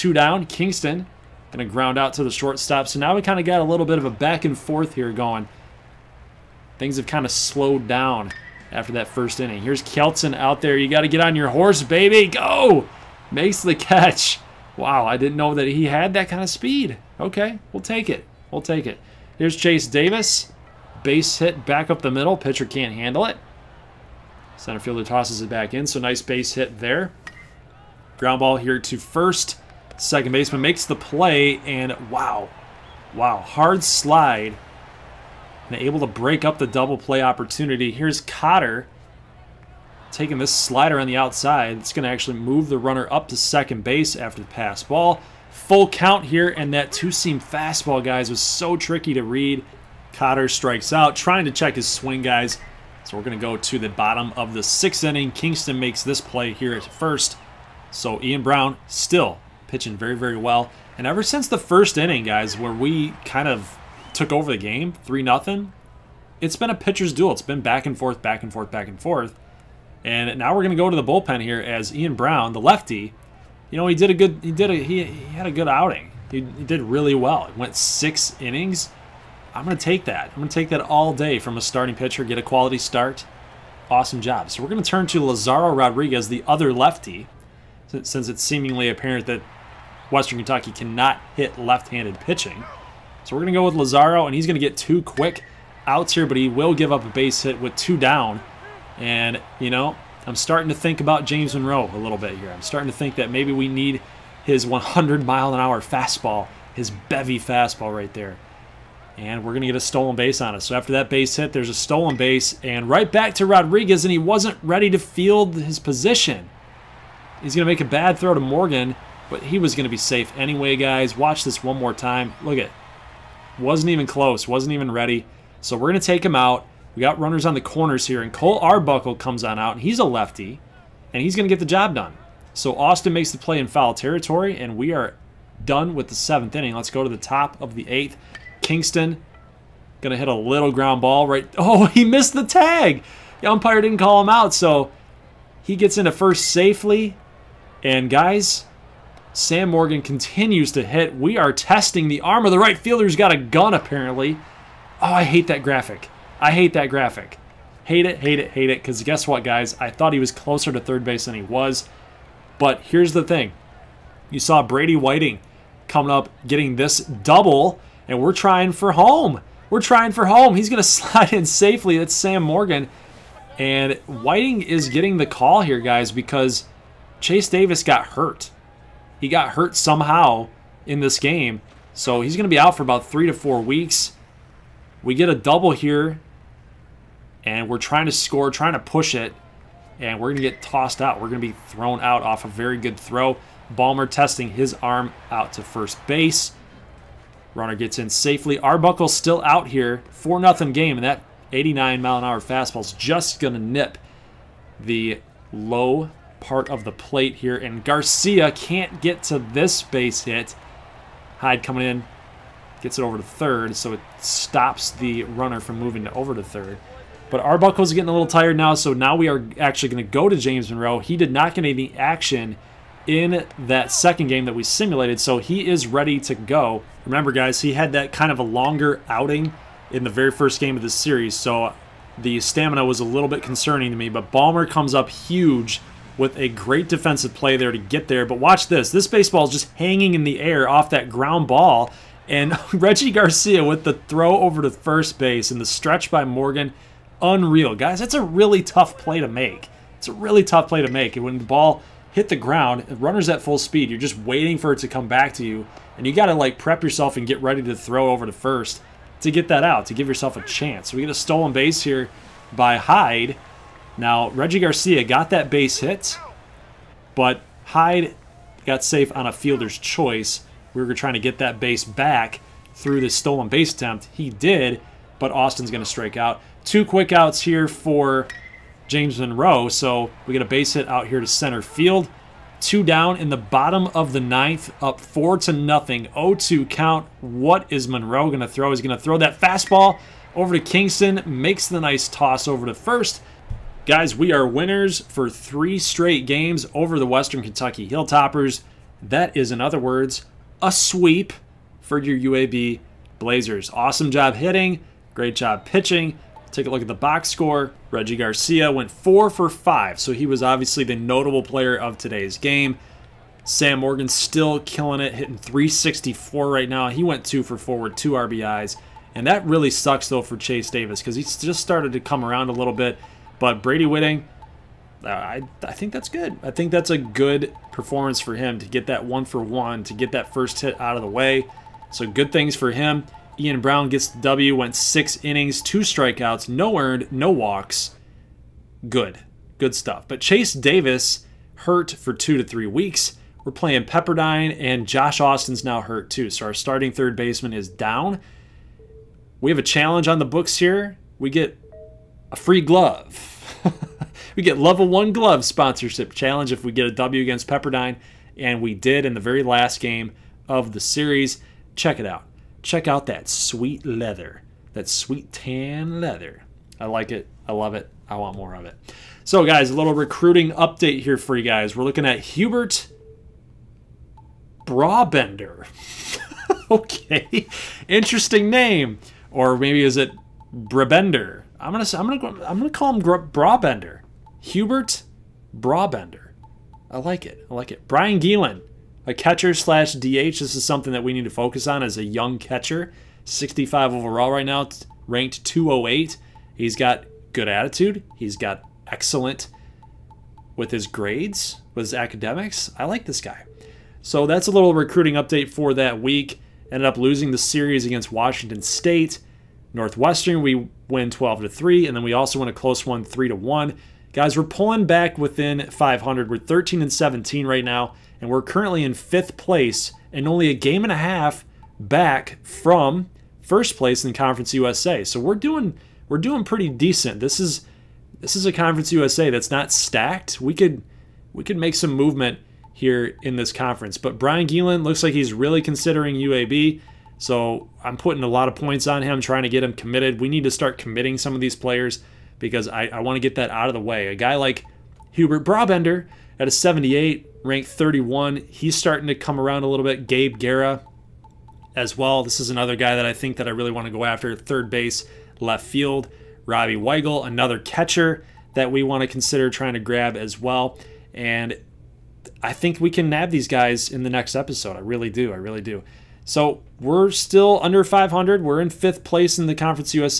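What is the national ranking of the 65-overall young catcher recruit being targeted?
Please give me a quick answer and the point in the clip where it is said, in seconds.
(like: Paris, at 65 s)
208, at 395 s.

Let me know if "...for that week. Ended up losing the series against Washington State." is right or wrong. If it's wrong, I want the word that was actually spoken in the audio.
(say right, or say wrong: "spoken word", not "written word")
right.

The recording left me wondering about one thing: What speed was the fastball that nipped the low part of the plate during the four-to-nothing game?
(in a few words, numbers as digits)
89 mph.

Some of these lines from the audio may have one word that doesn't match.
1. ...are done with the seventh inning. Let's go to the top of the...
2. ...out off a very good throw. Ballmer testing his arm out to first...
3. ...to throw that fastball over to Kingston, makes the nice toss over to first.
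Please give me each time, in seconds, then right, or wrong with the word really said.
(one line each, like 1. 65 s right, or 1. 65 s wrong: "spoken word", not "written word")
1. 134 s right
2. 191 s right
3. 288 s right.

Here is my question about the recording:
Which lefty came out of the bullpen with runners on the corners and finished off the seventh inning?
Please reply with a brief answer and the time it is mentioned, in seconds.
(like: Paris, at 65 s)
Cole Arbuckle, at 128 s.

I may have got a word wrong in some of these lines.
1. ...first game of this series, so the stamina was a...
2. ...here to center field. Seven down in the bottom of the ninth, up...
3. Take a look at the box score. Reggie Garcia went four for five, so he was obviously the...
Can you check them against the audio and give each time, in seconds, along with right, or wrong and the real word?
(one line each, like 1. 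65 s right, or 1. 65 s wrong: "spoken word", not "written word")
1. 230 s right
2. 281 s wrong: "Two", not "Seven"
3. 306 s right.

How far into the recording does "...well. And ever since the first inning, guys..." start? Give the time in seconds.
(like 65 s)
60 s.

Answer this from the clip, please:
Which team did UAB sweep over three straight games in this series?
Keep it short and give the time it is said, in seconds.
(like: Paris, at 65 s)
Western Kentucky Hilltoppers, at 297 s.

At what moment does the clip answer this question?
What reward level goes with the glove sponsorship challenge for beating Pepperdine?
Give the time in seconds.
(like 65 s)
354 s.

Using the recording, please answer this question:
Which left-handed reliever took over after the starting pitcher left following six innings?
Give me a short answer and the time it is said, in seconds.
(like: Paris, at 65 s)
Lazaro Rodriguez, at 85 s.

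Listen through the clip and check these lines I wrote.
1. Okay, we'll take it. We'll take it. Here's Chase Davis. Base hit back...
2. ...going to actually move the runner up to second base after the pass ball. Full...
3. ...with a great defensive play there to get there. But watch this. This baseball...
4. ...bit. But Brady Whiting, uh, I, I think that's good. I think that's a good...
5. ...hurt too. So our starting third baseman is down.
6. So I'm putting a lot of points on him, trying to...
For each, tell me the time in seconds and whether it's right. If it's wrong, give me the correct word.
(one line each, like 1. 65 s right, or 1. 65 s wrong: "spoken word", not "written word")
1. 17 s right
2. 41 s right
3. 236 s right
4. 322 s right
5. 345 s right
6. 437 s right.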